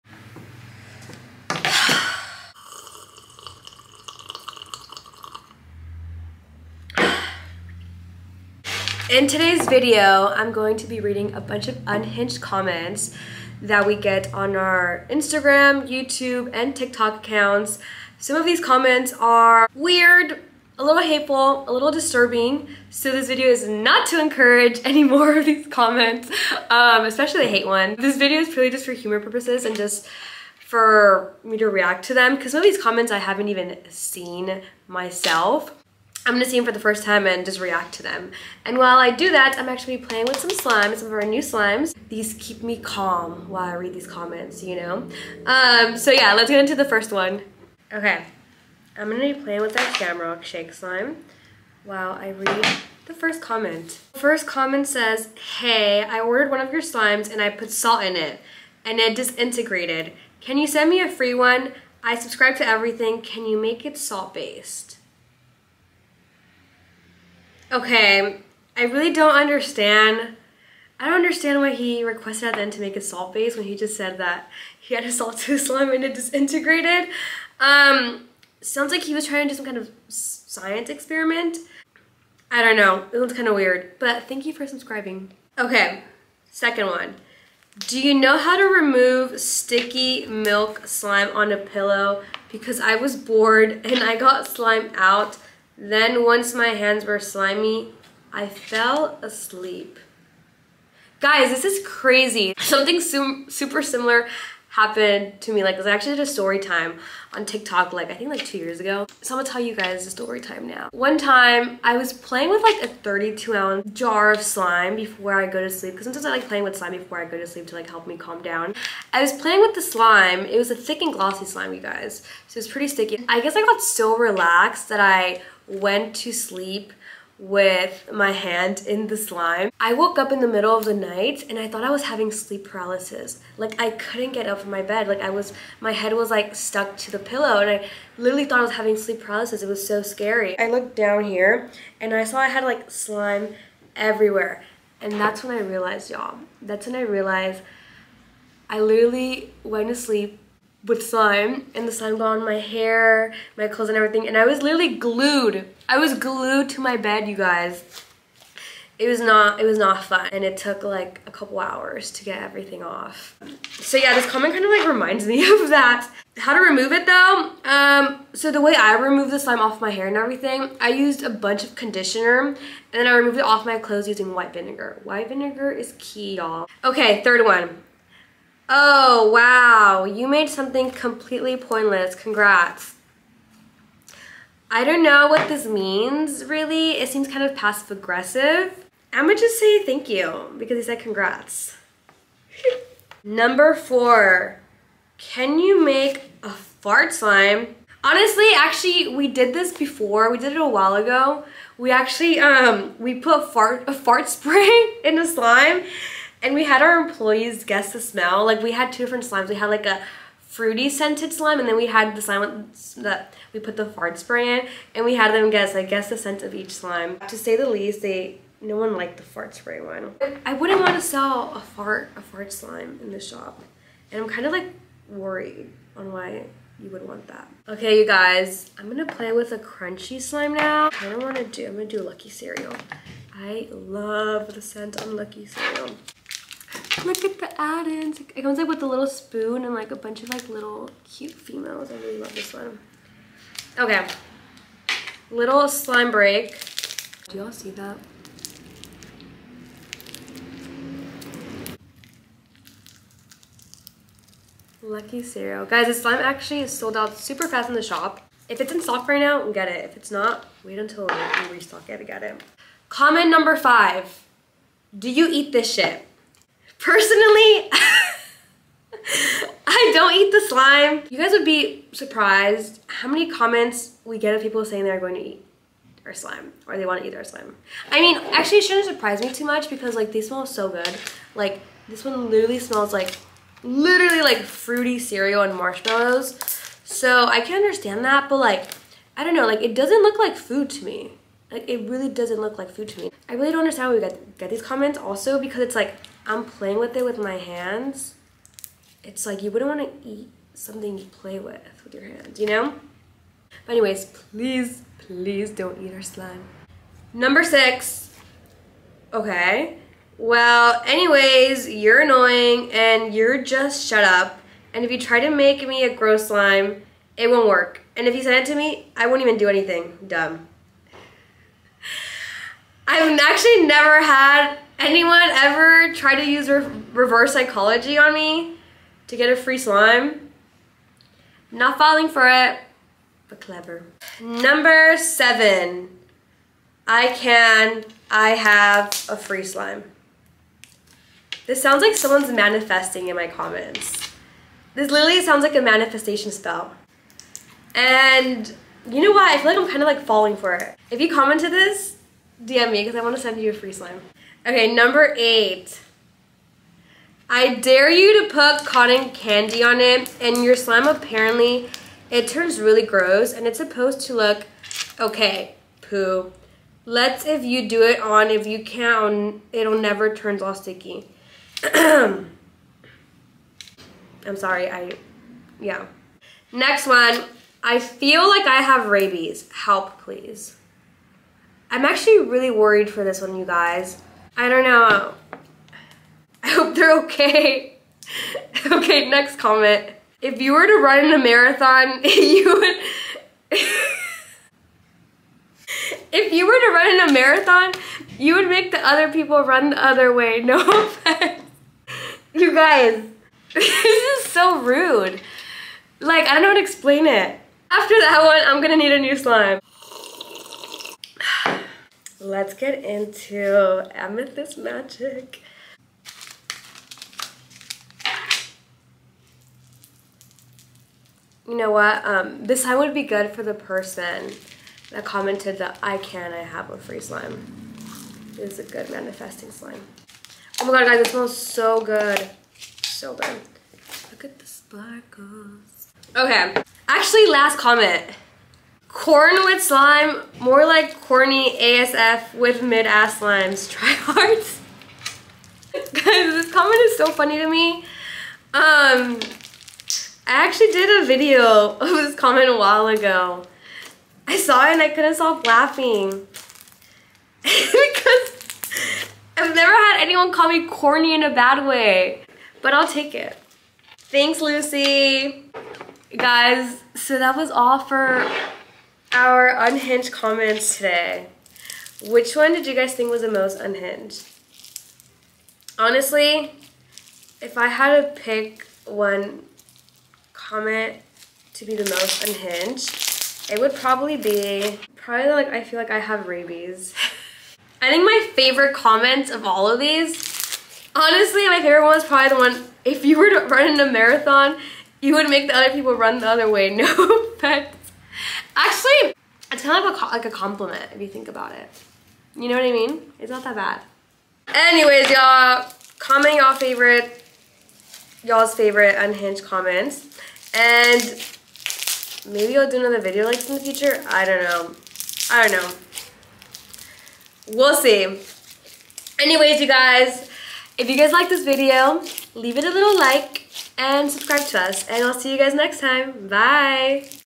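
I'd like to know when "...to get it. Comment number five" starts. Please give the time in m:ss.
4:21.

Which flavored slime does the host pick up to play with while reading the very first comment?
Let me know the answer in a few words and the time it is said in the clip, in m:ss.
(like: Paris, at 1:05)
Shamrock Shake, at 0:49.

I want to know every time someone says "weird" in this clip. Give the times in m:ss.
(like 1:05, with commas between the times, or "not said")
0:19, 1:23.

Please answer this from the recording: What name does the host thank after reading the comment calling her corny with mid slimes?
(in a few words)
Lucy.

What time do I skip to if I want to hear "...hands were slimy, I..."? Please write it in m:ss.
1:36.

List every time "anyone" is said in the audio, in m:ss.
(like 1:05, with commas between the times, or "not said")
5:24, 7:40.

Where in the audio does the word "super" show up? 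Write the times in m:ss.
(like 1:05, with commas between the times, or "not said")
1:43, 4:17.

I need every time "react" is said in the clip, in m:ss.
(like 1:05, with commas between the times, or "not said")
0:31, 0:37.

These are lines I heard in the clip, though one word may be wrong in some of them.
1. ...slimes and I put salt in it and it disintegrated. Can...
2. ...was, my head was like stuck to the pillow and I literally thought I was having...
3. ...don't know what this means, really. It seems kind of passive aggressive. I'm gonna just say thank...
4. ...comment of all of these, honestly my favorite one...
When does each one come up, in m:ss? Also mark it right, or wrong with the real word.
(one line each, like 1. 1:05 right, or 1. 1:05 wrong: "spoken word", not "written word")
1. 0:56 right
2. 2:15 right
3. 3:04 right
4. 8:08 right.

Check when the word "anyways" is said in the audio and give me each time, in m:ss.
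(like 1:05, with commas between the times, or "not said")
5:03, 5:10, 8:24, 8:39.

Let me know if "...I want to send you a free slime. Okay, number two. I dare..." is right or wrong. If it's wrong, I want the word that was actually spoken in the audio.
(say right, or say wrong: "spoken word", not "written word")
wrong: "eight", not "two".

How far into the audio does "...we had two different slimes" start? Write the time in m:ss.
3:28.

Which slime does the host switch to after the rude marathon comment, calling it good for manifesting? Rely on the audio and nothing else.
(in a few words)
Amethyst Magic.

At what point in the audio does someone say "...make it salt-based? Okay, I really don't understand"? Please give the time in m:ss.
1:03.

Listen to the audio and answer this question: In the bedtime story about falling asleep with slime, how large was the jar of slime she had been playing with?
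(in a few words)
32 ounce.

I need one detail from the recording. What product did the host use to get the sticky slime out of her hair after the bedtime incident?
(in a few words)
conditioner.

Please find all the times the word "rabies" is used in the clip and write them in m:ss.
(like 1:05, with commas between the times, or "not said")
6:18, 8:06.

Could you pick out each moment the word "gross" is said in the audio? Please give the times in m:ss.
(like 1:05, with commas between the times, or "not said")
5:15, 6:02.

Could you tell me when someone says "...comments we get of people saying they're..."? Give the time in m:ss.
4:33.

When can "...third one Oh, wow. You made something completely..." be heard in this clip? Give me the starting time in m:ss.
2:57.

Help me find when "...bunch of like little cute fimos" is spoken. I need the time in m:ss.
3:59.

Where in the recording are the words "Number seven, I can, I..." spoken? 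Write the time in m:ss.
5:34.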